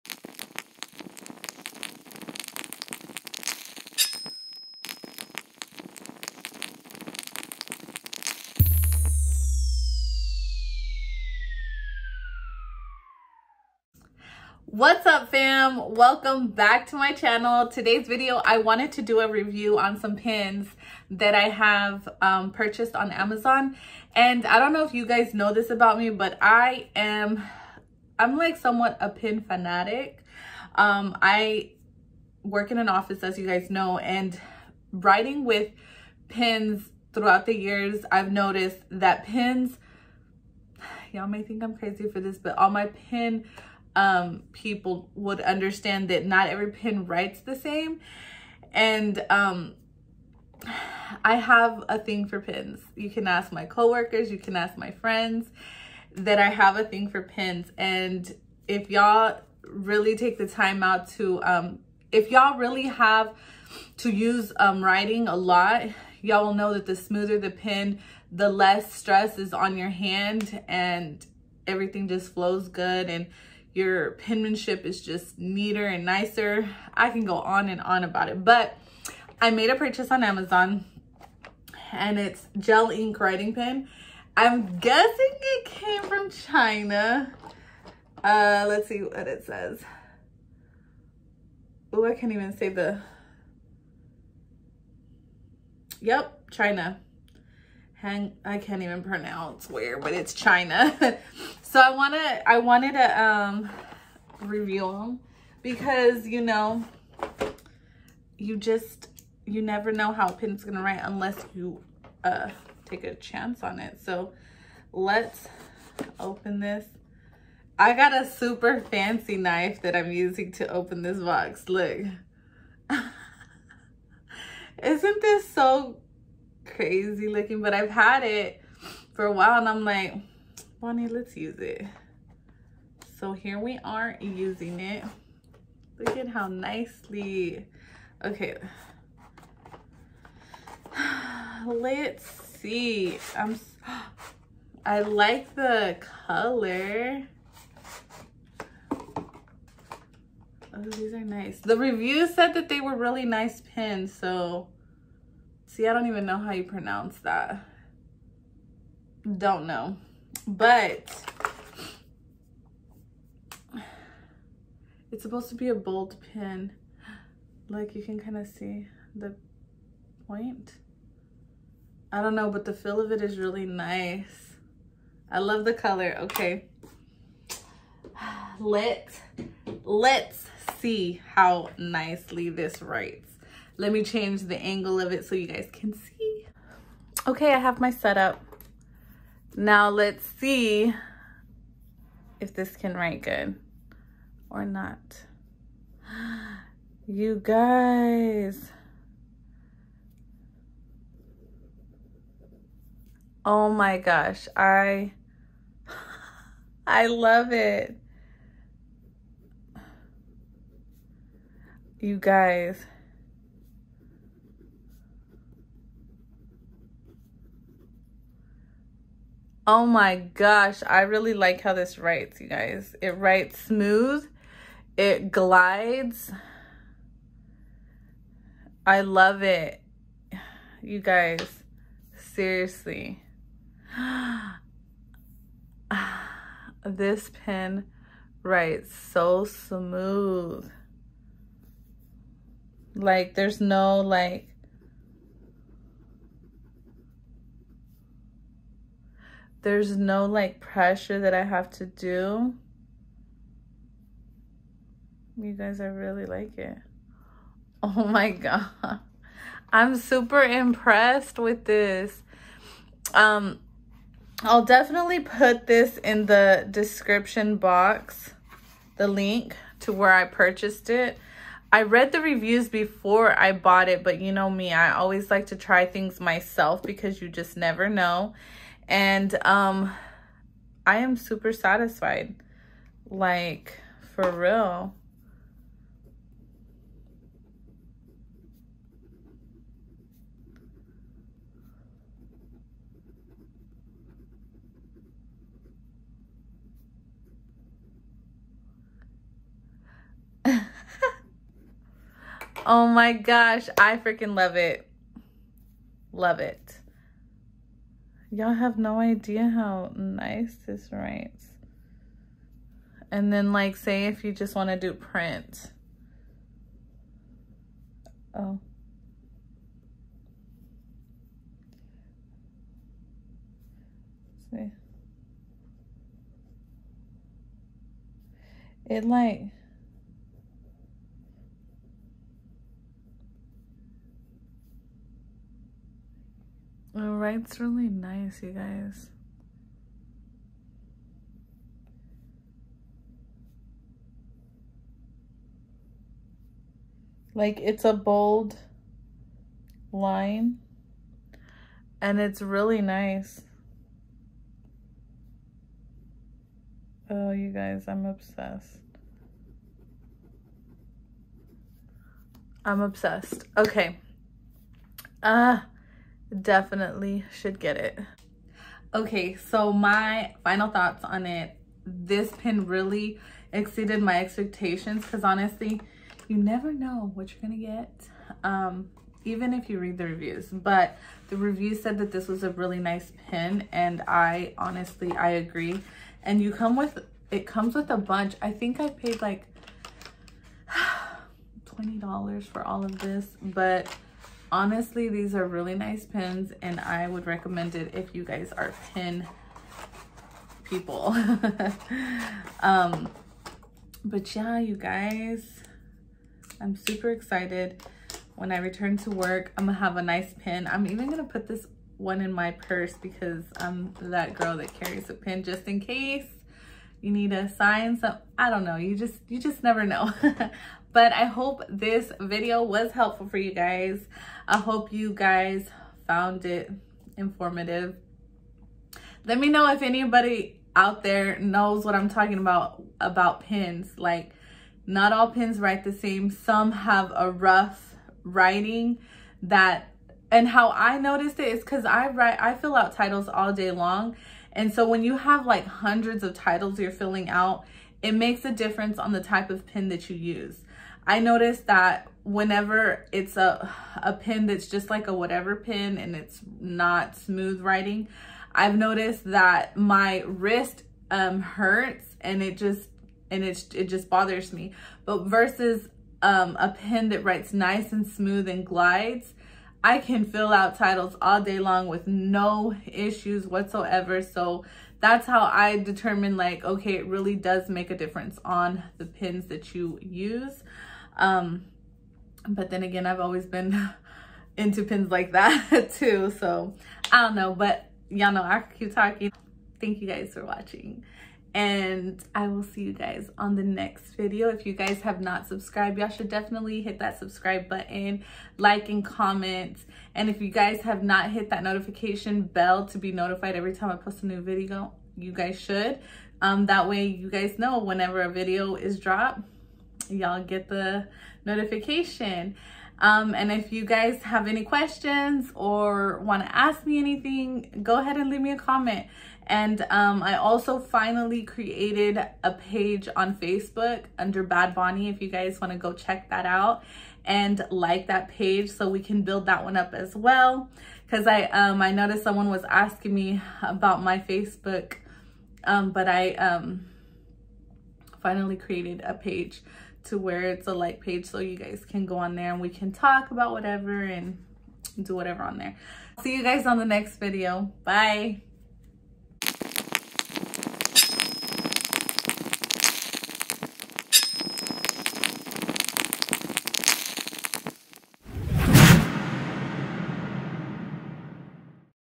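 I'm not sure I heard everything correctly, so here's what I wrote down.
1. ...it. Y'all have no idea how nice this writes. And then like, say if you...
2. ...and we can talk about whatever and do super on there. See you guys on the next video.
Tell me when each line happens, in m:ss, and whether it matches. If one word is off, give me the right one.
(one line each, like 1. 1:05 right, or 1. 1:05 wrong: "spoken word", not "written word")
1. 5:06 right
2. 9:02 wrong: "whatever", not "super".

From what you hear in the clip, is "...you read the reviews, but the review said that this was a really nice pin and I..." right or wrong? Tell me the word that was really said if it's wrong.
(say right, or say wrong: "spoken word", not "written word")
right.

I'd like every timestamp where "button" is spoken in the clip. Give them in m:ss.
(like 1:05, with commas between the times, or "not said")
8:17.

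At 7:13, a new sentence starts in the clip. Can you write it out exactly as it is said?
Like not all pins write the same.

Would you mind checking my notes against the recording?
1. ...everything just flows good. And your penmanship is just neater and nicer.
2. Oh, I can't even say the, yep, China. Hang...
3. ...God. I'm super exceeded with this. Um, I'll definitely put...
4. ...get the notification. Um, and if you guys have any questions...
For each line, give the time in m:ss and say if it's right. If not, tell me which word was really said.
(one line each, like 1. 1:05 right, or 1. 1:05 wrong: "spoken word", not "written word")
1. 1:11 right
2. 1:31 right
3. 4:18 wrong: "impressed", not "exceeded"
4. 8:30 right.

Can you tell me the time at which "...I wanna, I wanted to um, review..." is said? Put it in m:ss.
1:41.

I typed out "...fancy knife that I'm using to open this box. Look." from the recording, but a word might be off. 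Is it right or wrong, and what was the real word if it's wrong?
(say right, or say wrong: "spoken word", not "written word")
right.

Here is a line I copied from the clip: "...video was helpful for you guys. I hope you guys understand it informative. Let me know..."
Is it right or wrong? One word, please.
wrong.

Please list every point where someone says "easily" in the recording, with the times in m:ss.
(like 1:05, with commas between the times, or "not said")
not said.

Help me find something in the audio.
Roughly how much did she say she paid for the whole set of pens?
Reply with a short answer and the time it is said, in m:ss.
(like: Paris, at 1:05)
$20, at 6:31.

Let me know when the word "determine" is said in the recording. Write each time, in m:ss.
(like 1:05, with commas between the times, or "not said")
7:55.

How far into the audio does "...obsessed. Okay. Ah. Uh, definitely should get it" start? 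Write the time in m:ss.
6:02.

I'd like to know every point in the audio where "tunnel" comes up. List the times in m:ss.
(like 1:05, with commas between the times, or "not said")
not said.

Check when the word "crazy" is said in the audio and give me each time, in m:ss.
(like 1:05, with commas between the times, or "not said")
0:41, 2:06.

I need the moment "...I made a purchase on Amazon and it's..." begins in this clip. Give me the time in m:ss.
1:19.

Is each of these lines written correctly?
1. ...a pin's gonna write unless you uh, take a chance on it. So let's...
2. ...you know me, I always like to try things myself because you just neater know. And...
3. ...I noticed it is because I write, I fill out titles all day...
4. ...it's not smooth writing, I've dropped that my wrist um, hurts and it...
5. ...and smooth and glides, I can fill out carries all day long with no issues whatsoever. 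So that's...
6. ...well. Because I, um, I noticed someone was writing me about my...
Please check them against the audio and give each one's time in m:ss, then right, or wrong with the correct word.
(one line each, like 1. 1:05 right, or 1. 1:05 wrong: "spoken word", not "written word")
1. 1:50 right
2. 4:34 wrong: "never", not "neater"
3. 7:20 right
4. 7:36 wrong: "noticed", not "dropped"
5. 7:47 wrong: "titles", not "carries"
6. 8:50 wrong: "asking", not "writing".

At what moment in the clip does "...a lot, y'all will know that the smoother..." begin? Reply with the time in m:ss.
1:05.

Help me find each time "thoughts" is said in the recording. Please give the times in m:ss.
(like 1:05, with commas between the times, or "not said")
6:10.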